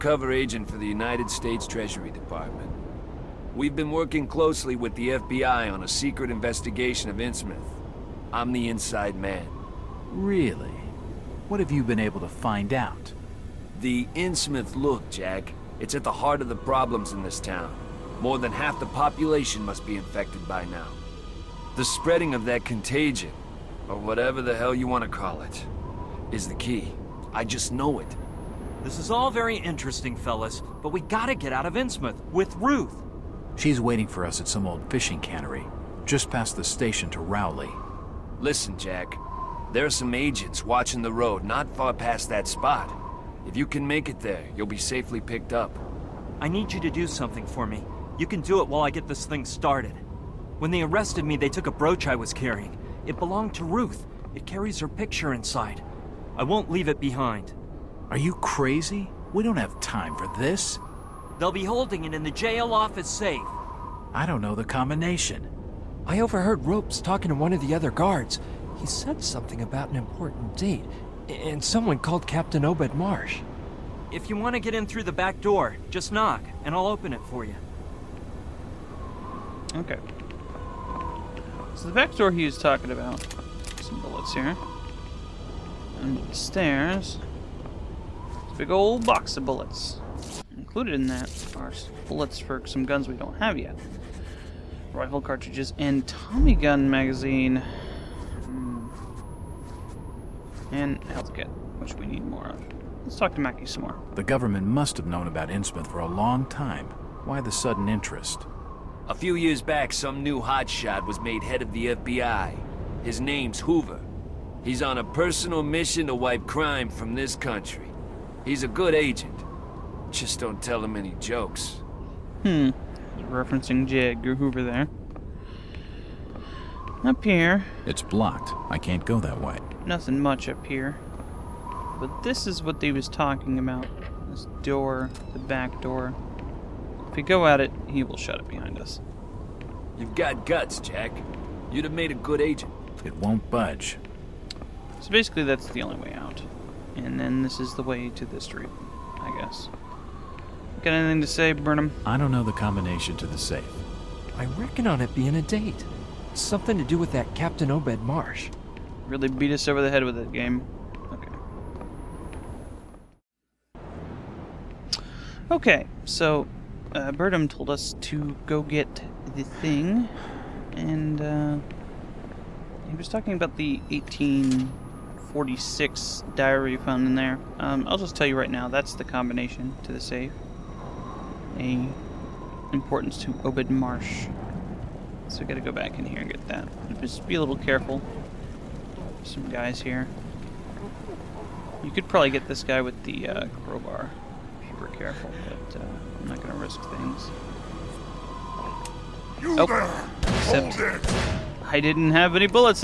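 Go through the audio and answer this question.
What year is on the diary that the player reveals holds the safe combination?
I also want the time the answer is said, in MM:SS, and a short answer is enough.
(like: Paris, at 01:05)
1846, at 02:53.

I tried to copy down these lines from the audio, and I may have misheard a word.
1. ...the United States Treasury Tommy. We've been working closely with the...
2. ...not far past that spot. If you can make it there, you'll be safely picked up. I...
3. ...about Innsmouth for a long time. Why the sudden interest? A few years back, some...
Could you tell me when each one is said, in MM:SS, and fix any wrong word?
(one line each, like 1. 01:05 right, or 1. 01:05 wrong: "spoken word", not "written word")
1. 00:00 wrong: "Department", not "Tommy"
2. 00:41 right
3. 01:45 right.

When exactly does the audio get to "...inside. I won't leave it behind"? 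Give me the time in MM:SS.
00:55.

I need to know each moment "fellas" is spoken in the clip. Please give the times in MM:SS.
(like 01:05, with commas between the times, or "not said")
00:30.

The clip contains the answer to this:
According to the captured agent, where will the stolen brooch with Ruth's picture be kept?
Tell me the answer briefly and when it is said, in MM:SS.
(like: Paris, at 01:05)
jail office safe, at 01:02.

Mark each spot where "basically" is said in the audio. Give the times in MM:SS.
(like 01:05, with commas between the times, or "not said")
02:25.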